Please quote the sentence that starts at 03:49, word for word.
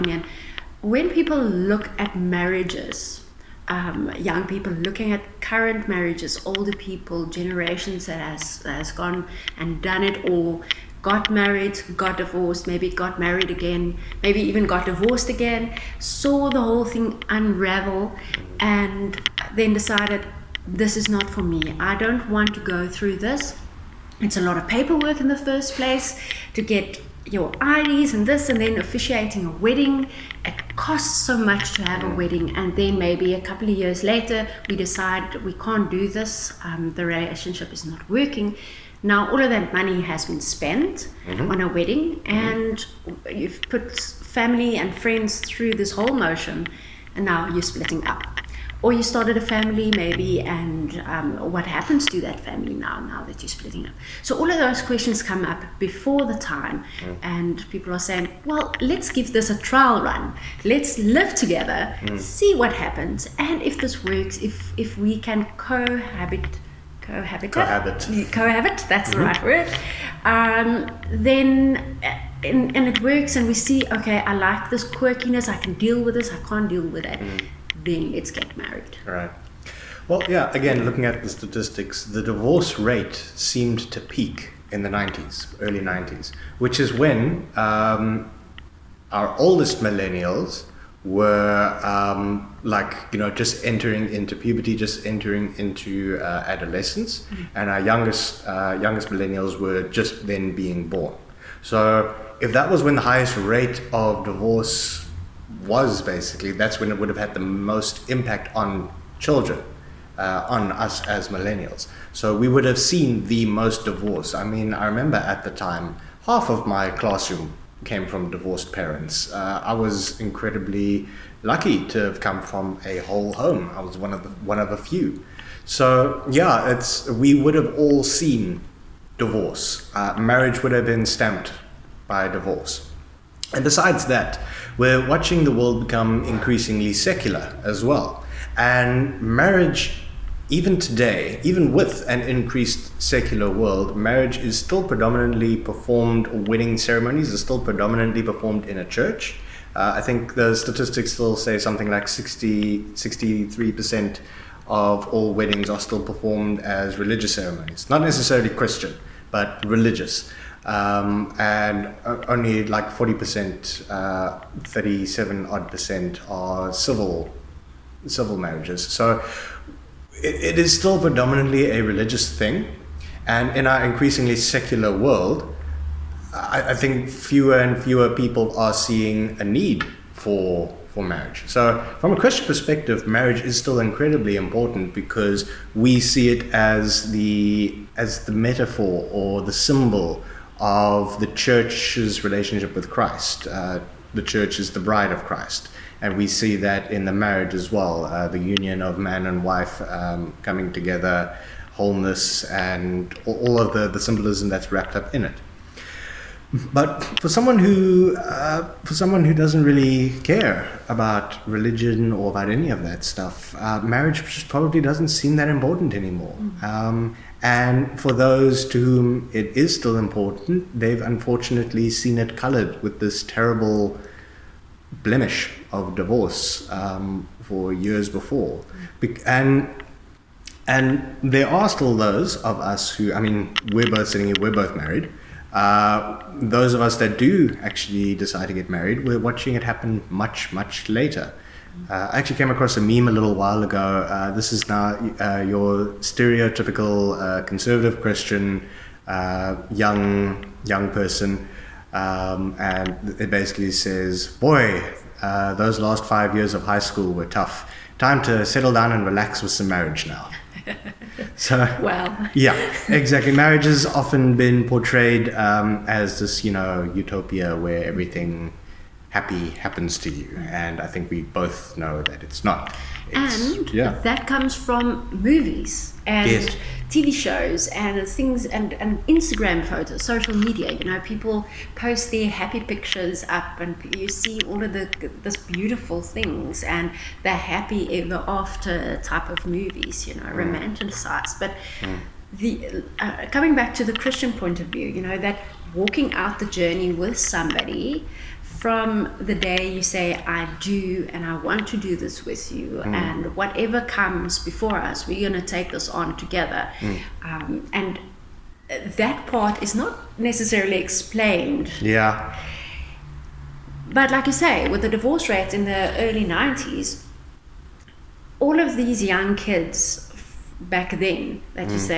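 and and there are still those of us who, I mean, we're both sitting here, we're both married.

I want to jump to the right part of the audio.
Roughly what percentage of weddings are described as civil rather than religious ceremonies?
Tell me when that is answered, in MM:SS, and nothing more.
02:44.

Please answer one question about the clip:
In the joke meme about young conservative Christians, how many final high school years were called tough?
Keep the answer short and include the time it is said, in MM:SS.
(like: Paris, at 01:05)
5, at 04:16.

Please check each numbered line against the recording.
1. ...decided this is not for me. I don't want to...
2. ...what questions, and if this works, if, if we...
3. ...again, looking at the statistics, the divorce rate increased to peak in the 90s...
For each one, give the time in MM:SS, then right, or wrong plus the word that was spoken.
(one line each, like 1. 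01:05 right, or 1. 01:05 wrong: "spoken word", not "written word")
1. 00:19 right
2. 01:02 wrong: "happens", not "questions"
3. 01:20 wrong: "seemed", not "increased".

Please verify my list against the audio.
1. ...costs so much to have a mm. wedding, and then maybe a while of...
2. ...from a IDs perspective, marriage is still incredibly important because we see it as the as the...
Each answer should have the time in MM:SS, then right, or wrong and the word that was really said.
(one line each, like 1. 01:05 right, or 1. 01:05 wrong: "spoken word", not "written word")
1. 00:30 wrong: "couple", not "while"
2. 03:01 wrong: "Christian", not "IDs".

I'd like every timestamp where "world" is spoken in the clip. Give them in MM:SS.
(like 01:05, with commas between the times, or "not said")
02:15, 02:23, 02:54.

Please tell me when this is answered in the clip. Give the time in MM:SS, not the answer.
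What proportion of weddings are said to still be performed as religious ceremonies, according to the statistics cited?
02:32.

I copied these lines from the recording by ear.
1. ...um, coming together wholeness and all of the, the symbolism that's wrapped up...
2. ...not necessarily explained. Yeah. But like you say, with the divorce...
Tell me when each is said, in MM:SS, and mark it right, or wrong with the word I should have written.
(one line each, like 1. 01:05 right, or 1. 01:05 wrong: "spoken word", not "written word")
1. 03:19 right
2. 05:09 right.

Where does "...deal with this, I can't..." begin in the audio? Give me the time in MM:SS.
01:15.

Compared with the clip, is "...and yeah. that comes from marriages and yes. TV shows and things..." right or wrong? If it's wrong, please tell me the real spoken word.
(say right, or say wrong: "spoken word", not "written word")
wrong: "movies", not "marriages".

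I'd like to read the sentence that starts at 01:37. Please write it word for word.
and our youngest uh, youngest millennials were just then being born.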